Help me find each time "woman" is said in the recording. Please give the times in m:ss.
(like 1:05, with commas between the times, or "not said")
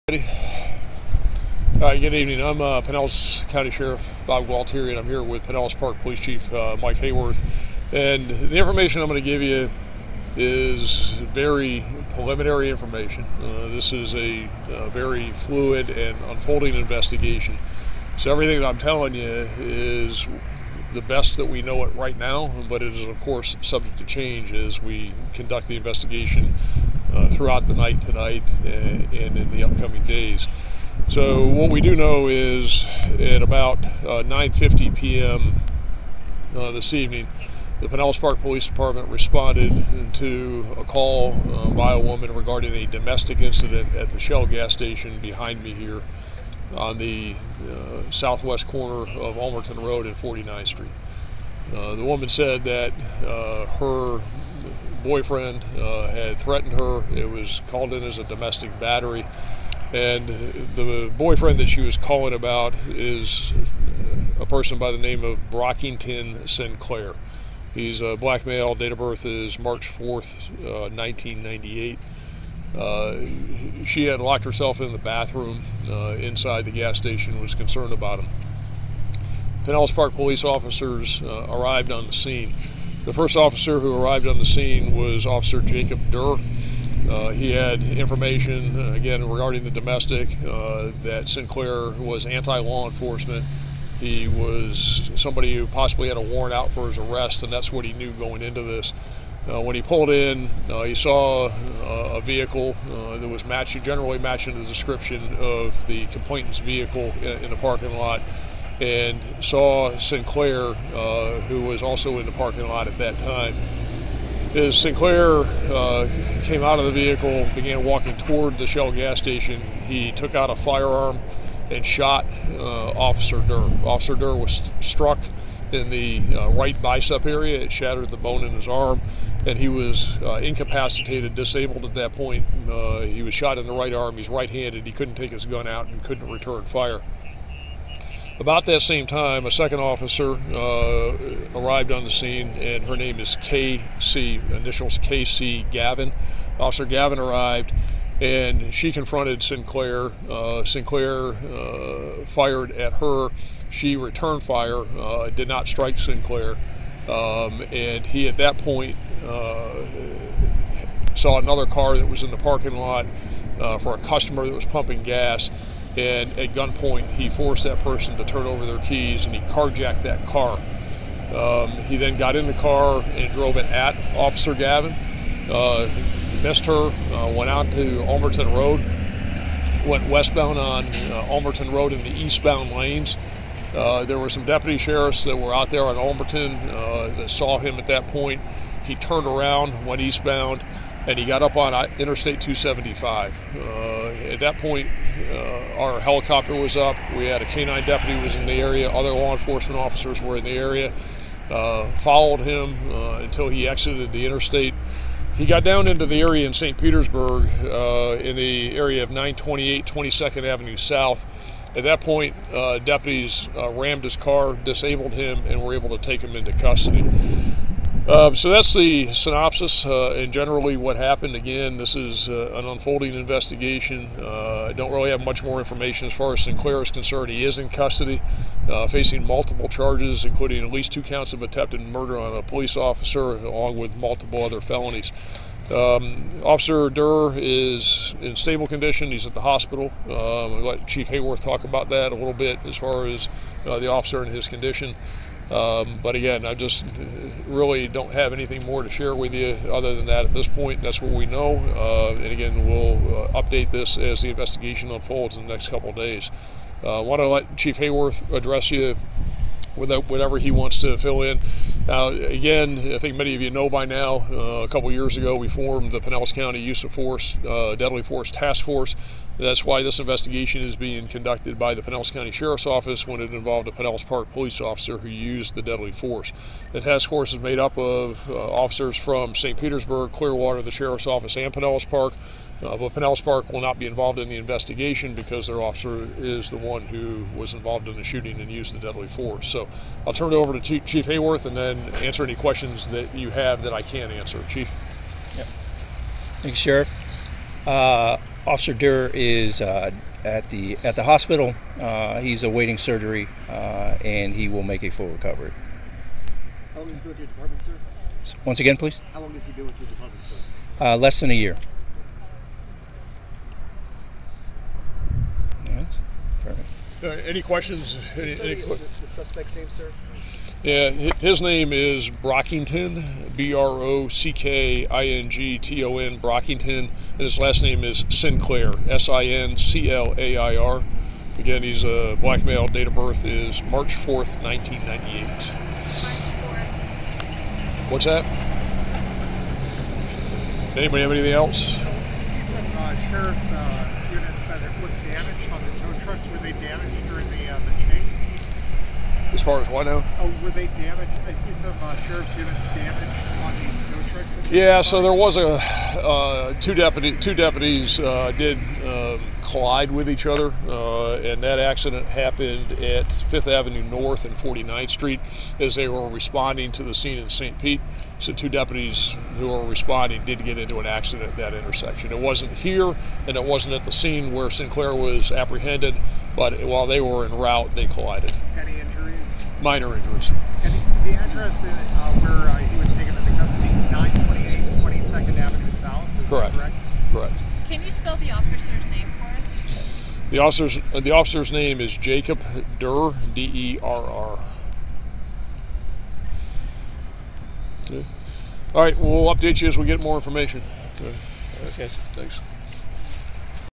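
0:41, 0:52.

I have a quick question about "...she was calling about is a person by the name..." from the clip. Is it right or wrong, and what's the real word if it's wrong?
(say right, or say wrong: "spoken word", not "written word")
right.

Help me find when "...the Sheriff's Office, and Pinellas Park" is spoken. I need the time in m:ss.
4:40.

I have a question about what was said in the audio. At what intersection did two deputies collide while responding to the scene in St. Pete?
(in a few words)
Fifth Avenue North and 49th Street.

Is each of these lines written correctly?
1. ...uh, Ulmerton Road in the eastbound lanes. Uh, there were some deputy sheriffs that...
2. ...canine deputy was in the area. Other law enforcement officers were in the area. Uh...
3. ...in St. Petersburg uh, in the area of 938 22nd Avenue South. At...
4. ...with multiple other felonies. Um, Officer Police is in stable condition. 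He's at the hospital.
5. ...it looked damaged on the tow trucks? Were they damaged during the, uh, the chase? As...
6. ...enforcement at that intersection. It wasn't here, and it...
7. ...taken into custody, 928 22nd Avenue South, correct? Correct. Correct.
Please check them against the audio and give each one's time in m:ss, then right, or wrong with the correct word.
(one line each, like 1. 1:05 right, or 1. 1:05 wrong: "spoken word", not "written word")
1. 3:00 right
2. 3:17 right
3. 3:26 wrong: "928", not "938"
4. 3:53 wrong: "Derr", not "Police"
5. 5:44 right
6. 6:10 wrong: "accident", not "enforcement"
7. 6:22 right.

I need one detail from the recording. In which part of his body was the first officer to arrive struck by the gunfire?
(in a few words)
Right bicep.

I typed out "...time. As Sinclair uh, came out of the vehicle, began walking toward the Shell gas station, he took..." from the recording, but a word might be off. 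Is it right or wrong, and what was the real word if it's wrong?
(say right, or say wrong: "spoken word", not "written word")
right.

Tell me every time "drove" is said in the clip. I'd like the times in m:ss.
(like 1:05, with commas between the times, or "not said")
2:53.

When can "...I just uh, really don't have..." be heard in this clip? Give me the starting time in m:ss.
4:06.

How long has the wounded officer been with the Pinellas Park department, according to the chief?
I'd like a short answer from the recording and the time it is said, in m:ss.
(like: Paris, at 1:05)
Less than a year, at 5:10.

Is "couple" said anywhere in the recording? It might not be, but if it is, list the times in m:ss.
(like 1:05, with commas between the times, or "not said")
4:15, 4:24.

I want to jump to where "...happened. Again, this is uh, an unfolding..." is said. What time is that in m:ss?
3:40.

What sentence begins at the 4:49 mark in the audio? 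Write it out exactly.
So I'll turn it over to Chief Haworth and then answer any questions that you have that I can answer.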